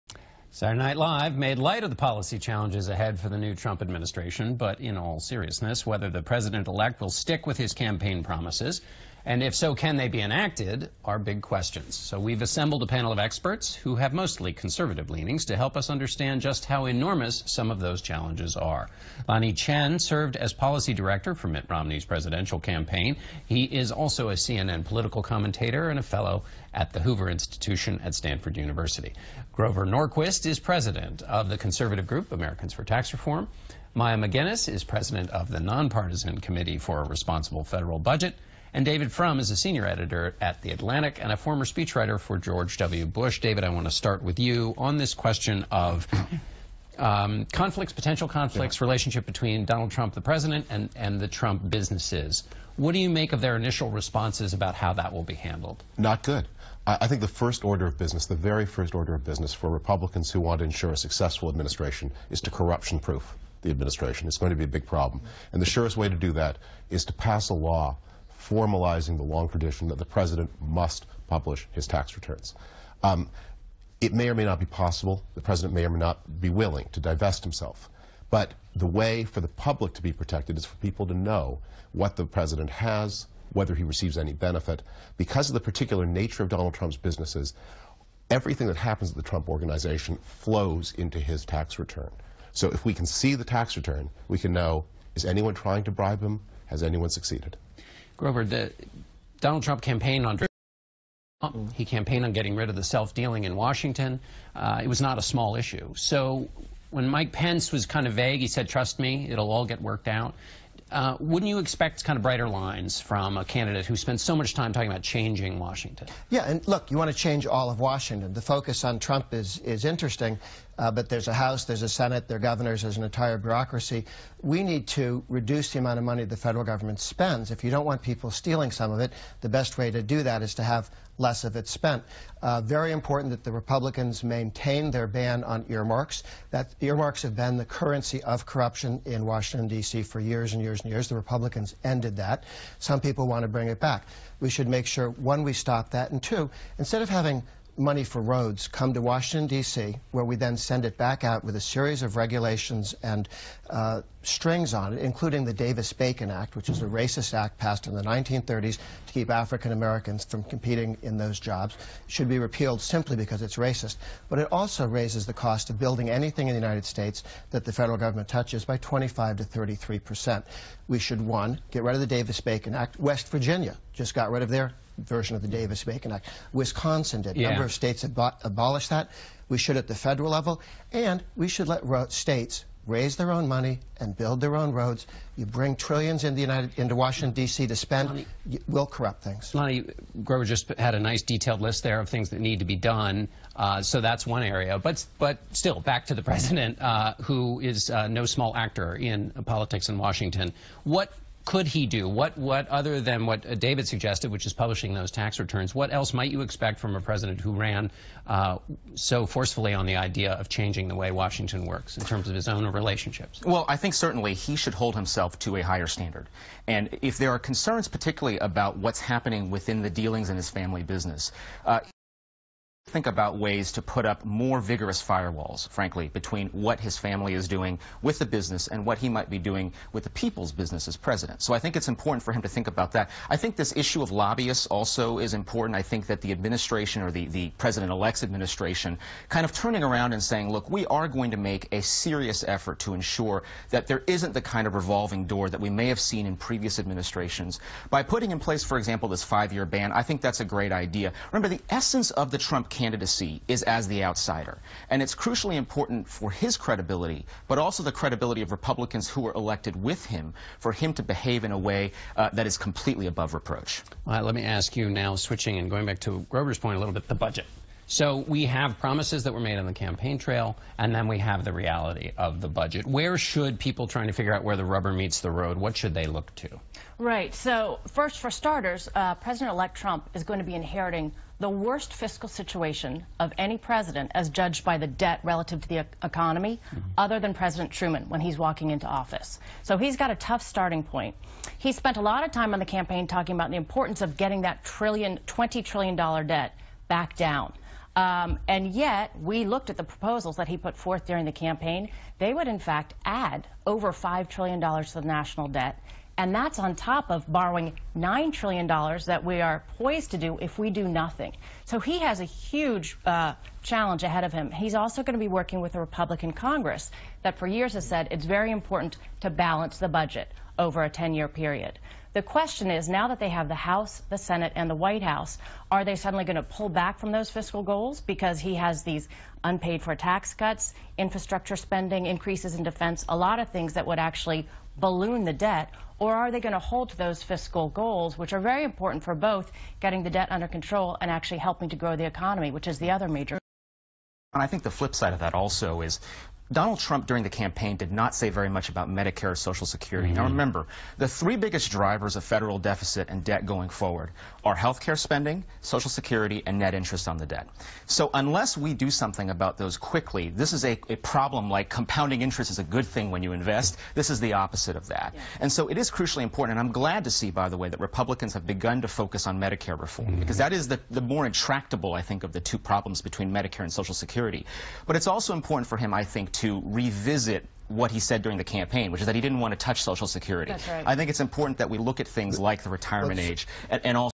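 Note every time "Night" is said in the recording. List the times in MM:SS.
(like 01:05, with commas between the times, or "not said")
00:00.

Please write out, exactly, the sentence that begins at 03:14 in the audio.
But but still, back to the president, uh, who is uh, no small actor in politics in Washington.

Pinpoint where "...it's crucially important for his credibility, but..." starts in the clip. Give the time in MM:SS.
04:15.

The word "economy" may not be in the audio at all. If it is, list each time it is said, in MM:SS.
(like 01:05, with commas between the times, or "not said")
04:46, 05:42.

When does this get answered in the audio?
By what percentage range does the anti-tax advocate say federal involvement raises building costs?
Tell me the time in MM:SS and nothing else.
02:48.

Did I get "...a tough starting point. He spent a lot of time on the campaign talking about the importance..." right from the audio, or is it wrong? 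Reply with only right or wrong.
right.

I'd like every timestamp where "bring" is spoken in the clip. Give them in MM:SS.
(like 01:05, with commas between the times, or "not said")
02:23, 03:05.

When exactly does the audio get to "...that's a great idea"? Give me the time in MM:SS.
04:10.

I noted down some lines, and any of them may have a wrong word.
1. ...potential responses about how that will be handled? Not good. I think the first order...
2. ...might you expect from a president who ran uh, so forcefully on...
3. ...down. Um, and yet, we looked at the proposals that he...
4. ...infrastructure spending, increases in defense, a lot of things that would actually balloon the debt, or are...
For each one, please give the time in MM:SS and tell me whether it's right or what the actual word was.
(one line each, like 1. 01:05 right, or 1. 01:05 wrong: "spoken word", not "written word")
1. 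00:53 wrong: "initial", not "potential"
2. 03:26 right
3. 04:57 right
4. 05:30 right.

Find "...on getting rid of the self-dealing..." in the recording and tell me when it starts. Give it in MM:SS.
01:42.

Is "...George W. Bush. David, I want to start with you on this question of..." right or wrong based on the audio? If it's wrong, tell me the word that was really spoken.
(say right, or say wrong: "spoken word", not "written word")
right.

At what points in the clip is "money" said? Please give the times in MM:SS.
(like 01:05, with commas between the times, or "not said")
02:06, 02:27, 03:03.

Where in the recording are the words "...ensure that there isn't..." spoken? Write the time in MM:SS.
04:02.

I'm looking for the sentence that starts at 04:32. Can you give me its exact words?
Where should people trying to figure out where the rubber meets the road, what should they look to?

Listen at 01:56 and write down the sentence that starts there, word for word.
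Yeah, and look, you want to change all of Washington.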